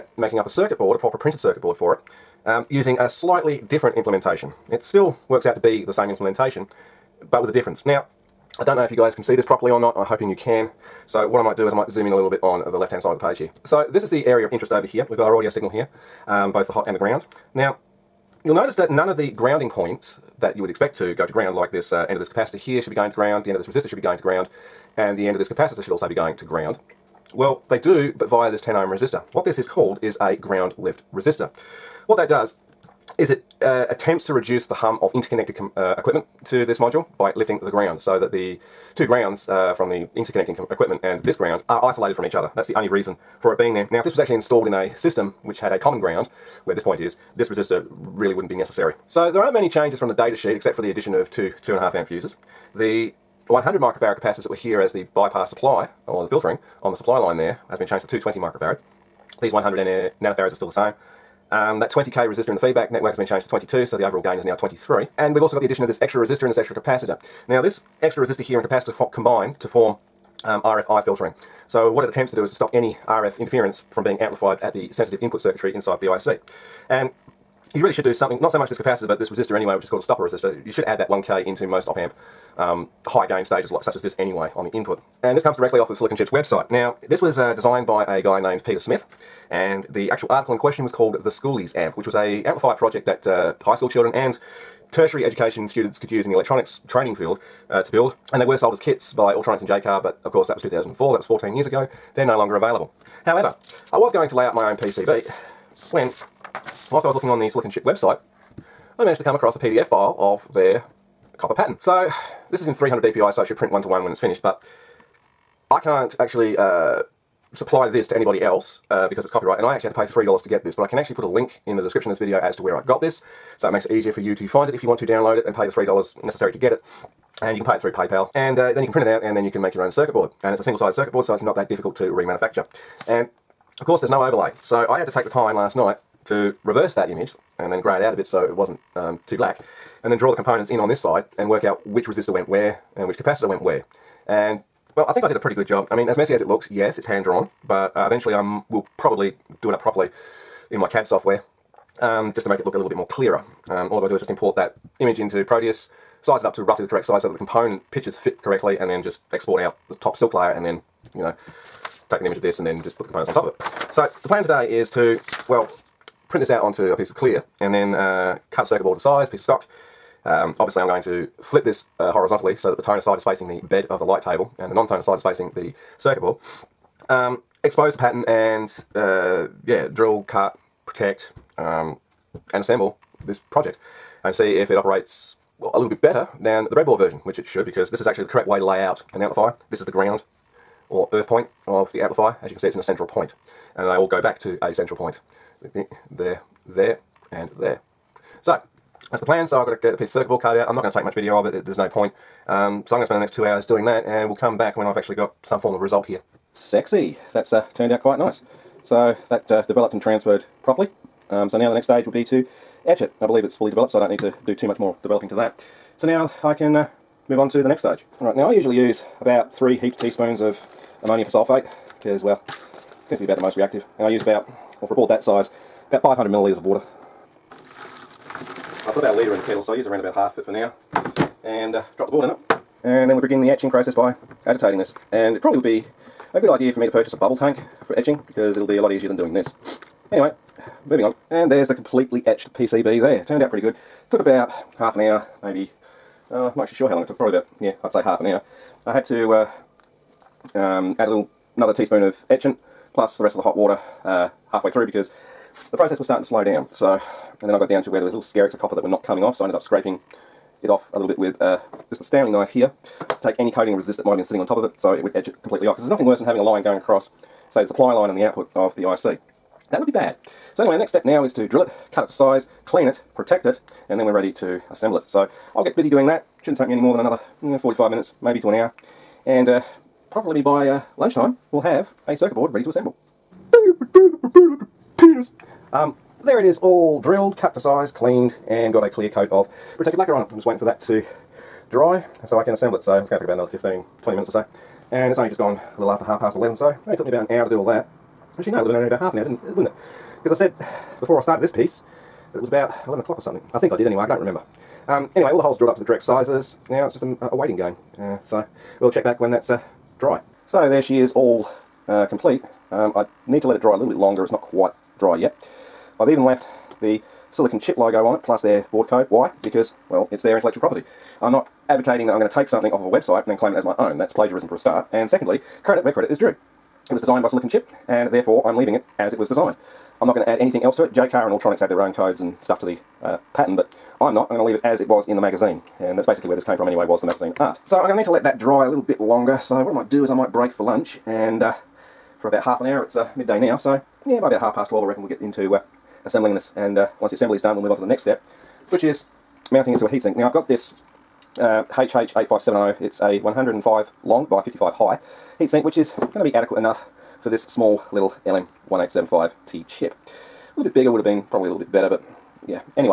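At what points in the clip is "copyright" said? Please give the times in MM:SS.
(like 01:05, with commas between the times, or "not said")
01:59.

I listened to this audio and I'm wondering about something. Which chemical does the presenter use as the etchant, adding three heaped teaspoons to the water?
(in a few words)
ammonium persulfate.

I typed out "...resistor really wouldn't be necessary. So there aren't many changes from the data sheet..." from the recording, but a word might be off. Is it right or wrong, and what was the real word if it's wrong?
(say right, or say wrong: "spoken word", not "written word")
right.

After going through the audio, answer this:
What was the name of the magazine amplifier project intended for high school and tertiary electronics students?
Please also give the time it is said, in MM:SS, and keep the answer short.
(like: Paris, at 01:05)
The Schoolies Amp, at 01:31.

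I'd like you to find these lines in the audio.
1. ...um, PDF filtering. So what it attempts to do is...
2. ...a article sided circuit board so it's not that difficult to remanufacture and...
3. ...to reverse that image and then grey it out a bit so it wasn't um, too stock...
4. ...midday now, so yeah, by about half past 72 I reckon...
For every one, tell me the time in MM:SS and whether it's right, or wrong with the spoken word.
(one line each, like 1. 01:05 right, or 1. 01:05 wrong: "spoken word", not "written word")
1. 01:10 wrong: "RFI", not "PDF"
2. 02:10 wrong: "single", not "article"
3. 02:16 wrong: "black", not "stock"
4. 05:43 wrong: "12", not "72".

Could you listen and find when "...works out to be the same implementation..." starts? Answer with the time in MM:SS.
00:05.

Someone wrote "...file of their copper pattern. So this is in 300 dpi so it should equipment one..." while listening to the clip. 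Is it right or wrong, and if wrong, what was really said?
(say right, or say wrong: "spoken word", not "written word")
wrong: "print", not "equipment".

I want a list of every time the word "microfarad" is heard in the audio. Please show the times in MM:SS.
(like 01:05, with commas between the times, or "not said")
00:53, 00:58.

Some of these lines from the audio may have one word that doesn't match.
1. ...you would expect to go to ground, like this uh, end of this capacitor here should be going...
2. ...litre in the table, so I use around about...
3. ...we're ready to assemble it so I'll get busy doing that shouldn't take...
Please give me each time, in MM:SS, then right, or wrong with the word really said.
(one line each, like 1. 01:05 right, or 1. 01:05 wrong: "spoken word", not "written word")
1. 00:20 right
2. 03:49 wrong: "kettle", not "table"
3. 04:34 right.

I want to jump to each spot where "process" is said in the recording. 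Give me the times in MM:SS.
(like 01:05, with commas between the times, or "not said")
03:53, 04:15.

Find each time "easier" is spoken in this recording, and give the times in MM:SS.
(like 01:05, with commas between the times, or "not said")
02:03, 03:58.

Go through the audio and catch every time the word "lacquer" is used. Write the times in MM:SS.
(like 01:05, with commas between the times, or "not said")
04:49.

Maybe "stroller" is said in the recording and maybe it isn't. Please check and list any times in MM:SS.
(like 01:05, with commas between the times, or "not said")
not said.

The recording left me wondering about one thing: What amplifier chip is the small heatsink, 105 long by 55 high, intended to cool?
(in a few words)
LM1875T.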